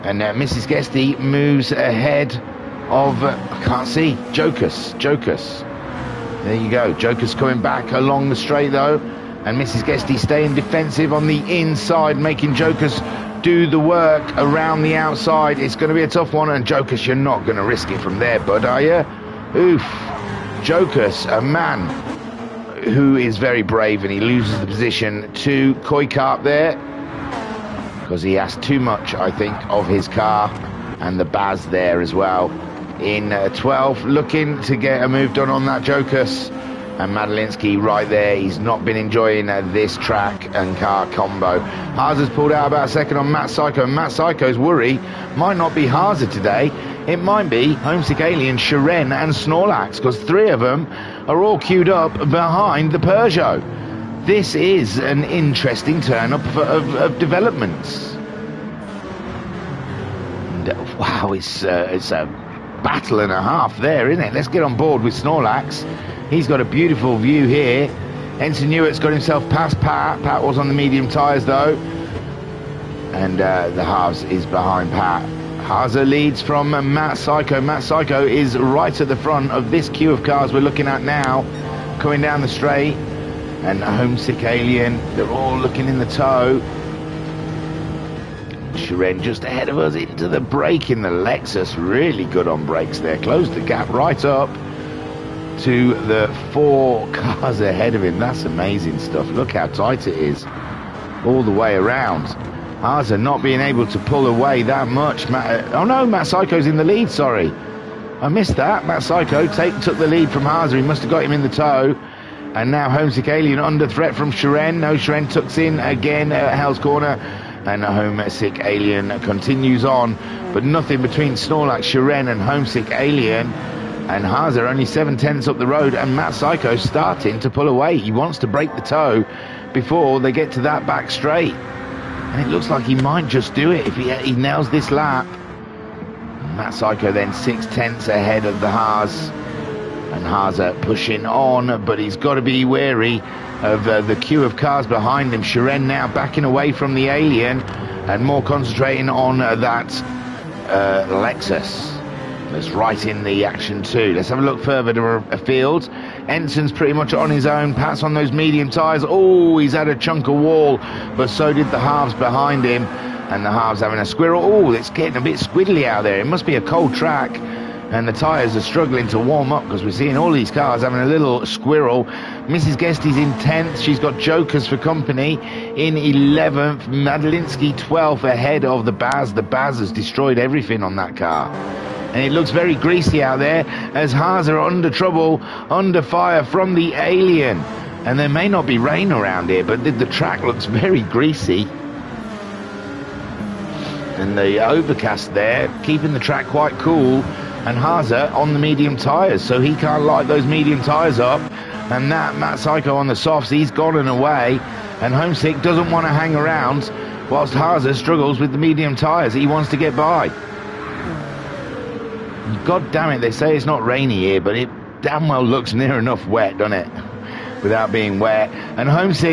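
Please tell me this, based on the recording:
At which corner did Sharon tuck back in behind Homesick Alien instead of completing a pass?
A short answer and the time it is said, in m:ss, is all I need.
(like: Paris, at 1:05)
Hell's Corner, at 1:56.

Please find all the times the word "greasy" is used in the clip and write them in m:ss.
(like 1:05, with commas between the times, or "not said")
3:02, 3:11.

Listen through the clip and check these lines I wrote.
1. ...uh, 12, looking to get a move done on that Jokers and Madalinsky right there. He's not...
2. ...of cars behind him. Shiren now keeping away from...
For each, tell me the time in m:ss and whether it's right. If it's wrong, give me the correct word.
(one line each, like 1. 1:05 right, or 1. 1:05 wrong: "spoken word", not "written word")
1. 0:33 right
2. 2:24 wrong: "backing", not "keeping".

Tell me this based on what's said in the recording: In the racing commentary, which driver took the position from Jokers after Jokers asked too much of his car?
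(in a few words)
Koikarp.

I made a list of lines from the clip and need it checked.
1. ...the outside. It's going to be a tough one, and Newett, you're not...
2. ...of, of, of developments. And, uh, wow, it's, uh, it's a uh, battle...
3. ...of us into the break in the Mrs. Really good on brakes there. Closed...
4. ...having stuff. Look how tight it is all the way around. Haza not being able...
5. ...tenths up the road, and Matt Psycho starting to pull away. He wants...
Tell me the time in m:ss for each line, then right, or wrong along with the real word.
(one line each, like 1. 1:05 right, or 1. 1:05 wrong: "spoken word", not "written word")
1. 0:14 wrong: "Jokers", not "Newett"
2. 0:56 right
3. 1:29 wrong: "Lexus", not "Mrs"
4. 1:38 wrong: "amazing", not "having"
5. 2:05 right.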